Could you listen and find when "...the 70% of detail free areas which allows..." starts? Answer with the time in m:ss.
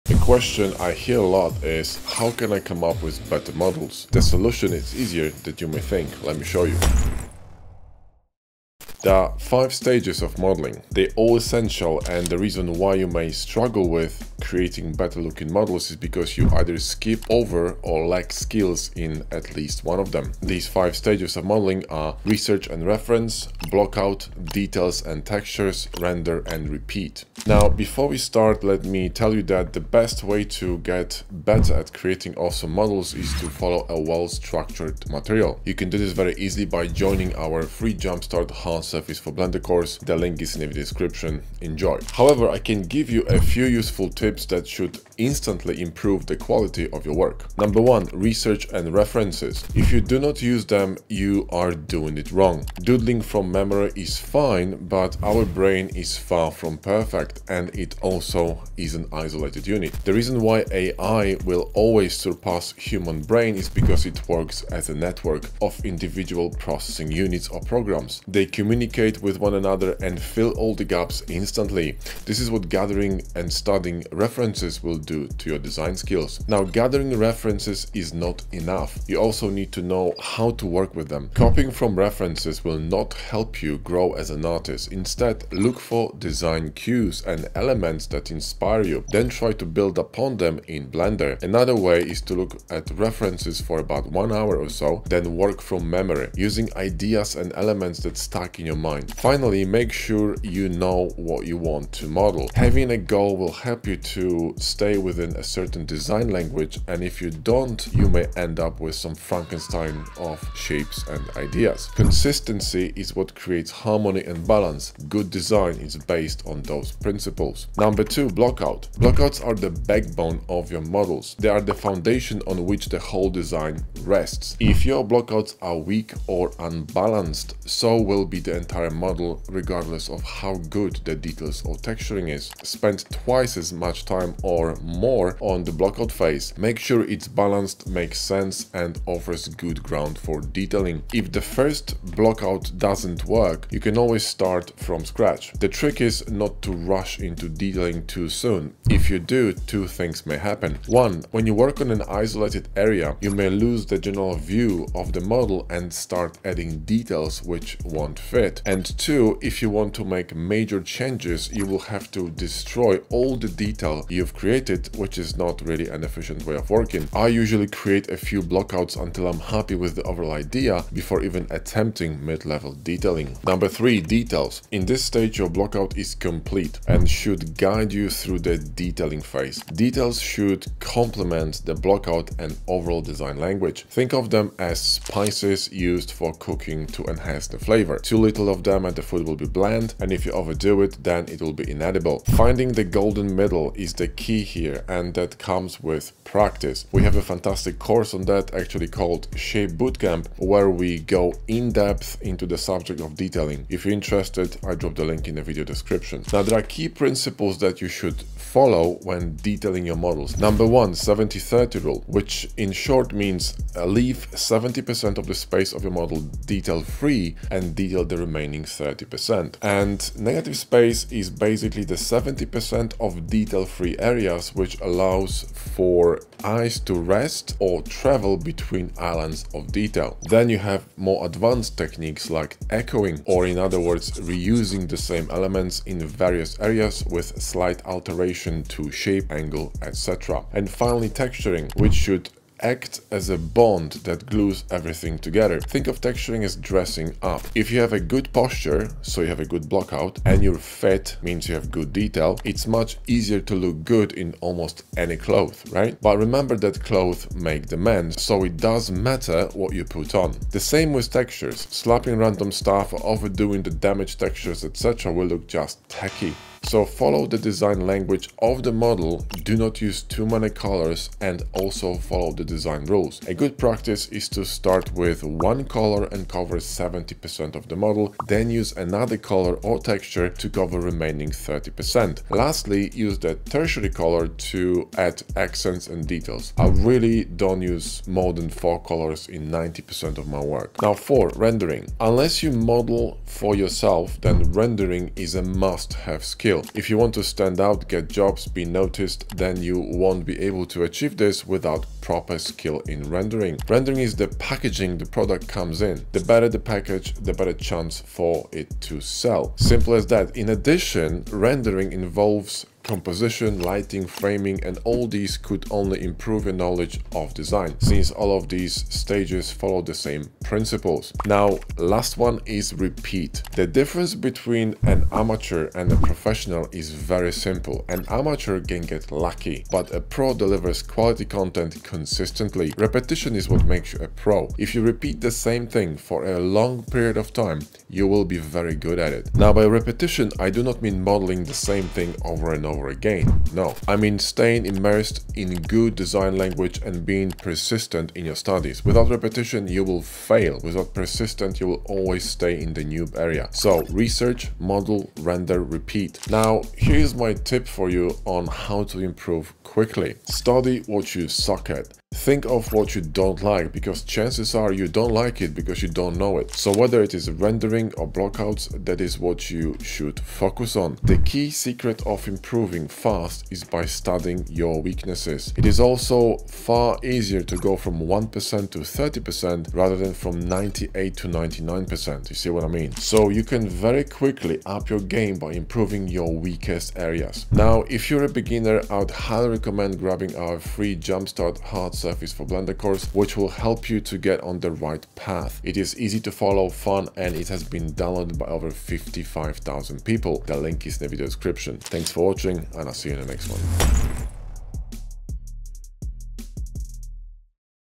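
3:41.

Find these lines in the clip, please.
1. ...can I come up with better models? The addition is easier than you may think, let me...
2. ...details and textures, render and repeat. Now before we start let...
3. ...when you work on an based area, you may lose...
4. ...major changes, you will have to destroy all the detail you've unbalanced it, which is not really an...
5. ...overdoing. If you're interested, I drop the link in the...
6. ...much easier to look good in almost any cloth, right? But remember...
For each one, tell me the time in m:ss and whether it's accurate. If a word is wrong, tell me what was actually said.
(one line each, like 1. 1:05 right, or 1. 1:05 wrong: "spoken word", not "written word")
1. 0:02 wrong: "solution", not "addition"
2. 0:24 right
3. 2:31 wrong: "isolated", not "based"
4. 2:40 wrong: "created", not "unbalanced"
5. 3:23 wrong: "detailing", not "overdoing"
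6. 4:12 right.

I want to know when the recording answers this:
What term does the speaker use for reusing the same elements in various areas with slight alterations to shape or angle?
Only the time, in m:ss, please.
3:52.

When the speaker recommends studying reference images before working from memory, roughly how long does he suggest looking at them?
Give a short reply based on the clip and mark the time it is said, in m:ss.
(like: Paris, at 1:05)
1 hour, at 1:34.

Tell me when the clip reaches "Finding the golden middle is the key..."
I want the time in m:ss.
3:12.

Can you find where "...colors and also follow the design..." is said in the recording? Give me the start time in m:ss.
4:30.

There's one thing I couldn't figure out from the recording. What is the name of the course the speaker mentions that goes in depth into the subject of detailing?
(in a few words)
Shape Bootcamp.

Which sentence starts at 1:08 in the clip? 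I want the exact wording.
They communicate with one another and fill all the gaps instantly.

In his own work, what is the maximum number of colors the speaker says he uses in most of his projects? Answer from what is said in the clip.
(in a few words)
4.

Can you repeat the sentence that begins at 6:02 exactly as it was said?
Think of what you don't like, because chances are you don't like it because you don't know it.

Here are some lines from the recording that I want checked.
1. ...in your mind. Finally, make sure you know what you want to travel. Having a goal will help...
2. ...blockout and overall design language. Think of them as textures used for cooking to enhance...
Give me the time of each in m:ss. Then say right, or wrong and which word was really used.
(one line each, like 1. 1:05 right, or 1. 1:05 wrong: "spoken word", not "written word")
1. 1:38 wrong: "model", not "travel"
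2. 3:01 wrong: "spices", not "textures".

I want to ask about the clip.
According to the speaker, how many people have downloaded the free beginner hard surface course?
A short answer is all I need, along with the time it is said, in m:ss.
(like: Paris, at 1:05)
55,000, at 6:38.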